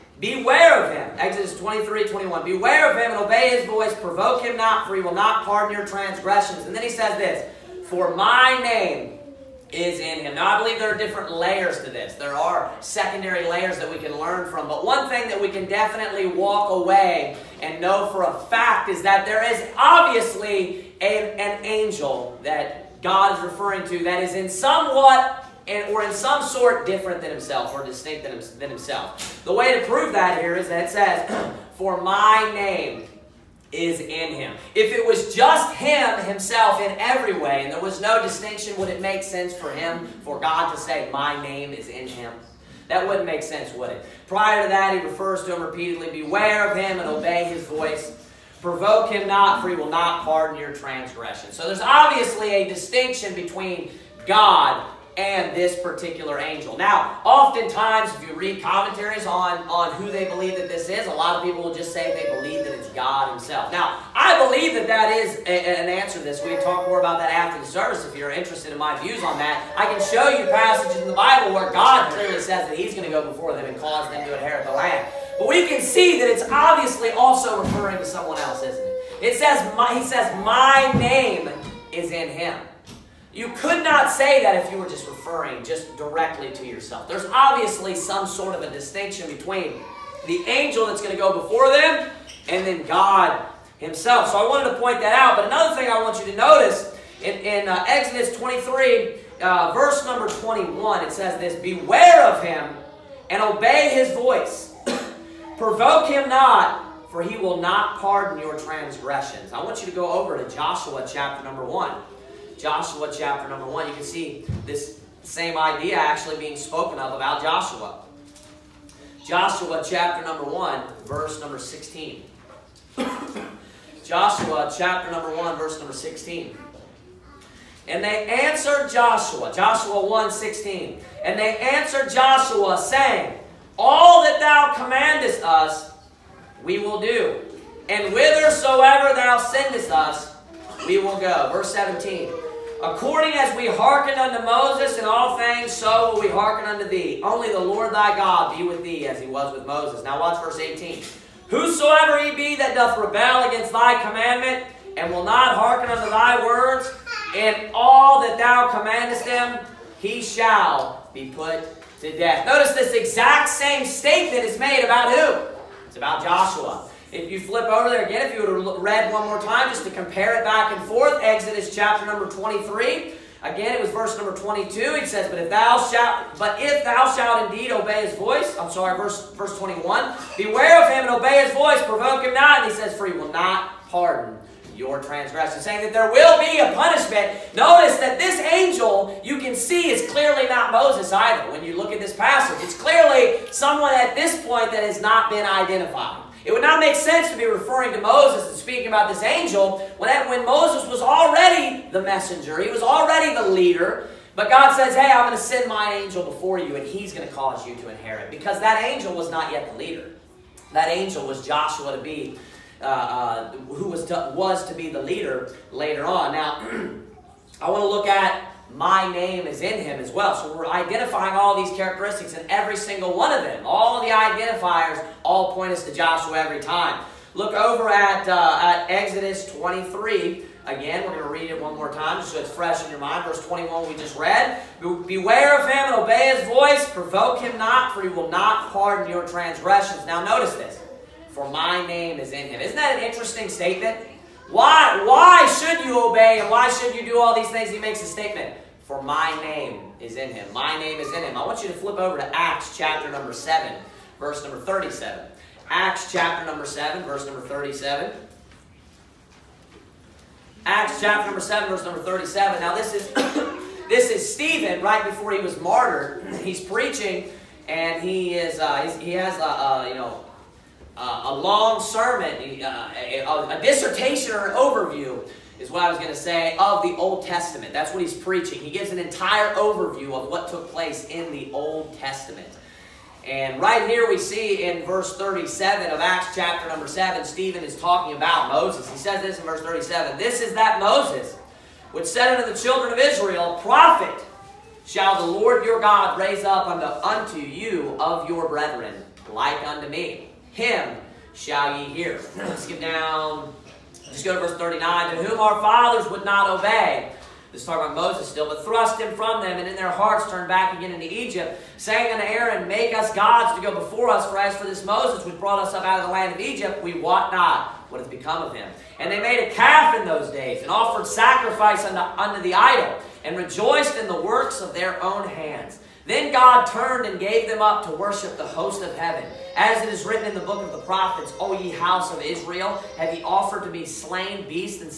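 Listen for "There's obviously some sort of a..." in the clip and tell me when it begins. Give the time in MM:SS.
01:27.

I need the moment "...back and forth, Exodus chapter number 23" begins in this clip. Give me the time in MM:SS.
02:50.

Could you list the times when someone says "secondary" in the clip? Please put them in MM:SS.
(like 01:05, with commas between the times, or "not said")
00:12.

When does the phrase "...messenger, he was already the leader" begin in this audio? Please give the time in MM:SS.
03:22.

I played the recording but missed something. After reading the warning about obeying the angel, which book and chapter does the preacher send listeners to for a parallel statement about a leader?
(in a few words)
Joshua 1.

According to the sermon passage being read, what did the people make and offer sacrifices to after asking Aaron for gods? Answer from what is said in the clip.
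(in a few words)
A calf.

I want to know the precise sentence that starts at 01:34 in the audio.
So I wanted to point that out.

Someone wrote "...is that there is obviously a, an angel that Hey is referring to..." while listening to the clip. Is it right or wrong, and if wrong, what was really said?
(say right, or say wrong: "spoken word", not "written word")
wrong: "God", not "Hey".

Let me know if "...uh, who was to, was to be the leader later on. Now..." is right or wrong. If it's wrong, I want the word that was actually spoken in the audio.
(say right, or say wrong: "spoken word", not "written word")
right.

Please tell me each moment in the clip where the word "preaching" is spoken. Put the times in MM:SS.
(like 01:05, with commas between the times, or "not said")
04:26, 04:38.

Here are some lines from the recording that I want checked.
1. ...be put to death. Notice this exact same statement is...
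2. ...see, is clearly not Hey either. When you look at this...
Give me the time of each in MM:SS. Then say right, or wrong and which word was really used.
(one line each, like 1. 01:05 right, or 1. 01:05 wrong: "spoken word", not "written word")
1. 02:41 right
2. 03:09 wrong: "Moses", not "Hey".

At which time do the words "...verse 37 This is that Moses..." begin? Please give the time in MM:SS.
04:49.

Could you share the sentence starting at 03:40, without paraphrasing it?
So we're identifying all these characteristics and every single one of them.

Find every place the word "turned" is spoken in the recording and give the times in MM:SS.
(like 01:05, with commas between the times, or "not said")
05:10, 05:26.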